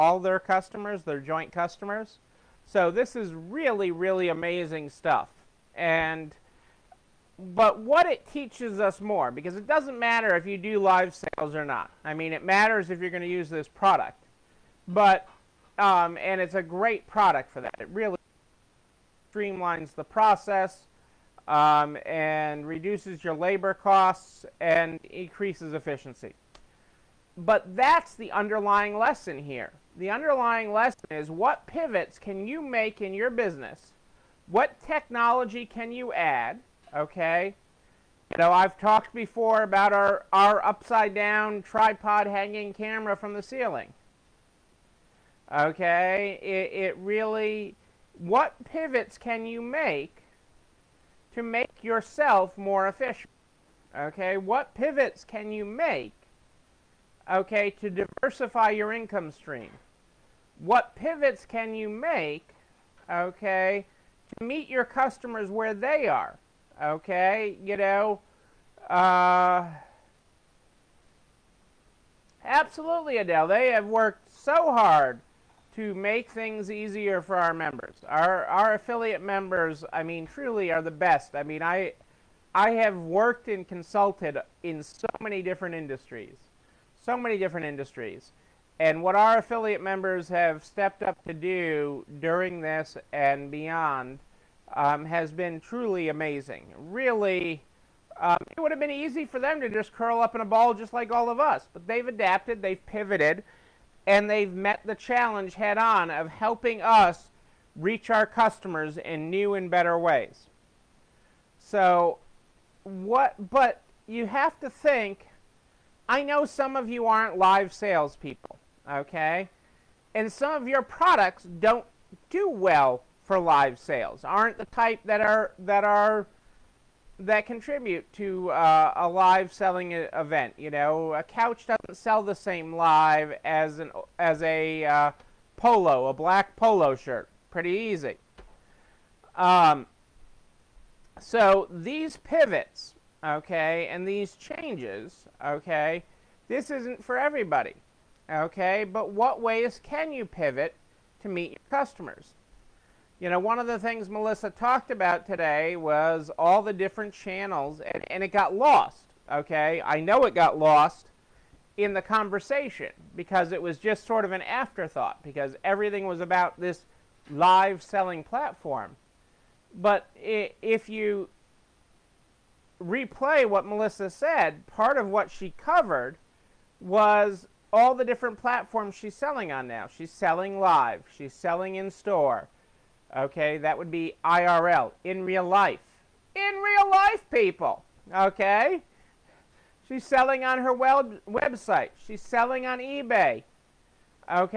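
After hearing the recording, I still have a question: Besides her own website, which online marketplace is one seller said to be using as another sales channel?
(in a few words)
eBay.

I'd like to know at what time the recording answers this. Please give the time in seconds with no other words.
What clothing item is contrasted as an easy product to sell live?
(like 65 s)
136 s.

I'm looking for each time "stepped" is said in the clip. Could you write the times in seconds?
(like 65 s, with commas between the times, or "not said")
90 s.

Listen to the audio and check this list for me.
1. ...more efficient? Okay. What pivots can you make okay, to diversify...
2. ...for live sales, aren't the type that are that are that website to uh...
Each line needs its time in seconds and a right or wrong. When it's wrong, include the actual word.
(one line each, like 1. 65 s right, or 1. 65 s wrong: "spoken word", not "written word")
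1. 52 s right
2. 123 s wrong: "contribute", not "website".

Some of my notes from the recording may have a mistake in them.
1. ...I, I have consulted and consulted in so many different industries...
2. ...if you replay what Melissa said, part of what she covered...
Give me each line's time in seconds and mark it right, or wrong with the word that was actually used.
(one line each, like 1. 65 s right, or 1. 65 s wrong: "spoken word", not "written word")
1. 81 s wrong: "worked", not "consulted"
2. 170 s right.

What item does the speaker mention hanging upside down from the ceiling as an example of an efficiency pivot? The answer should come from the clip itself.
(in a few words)
tripod.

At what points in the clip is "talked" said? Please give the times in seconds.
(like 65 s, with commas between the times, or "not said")
38 s, 154 s.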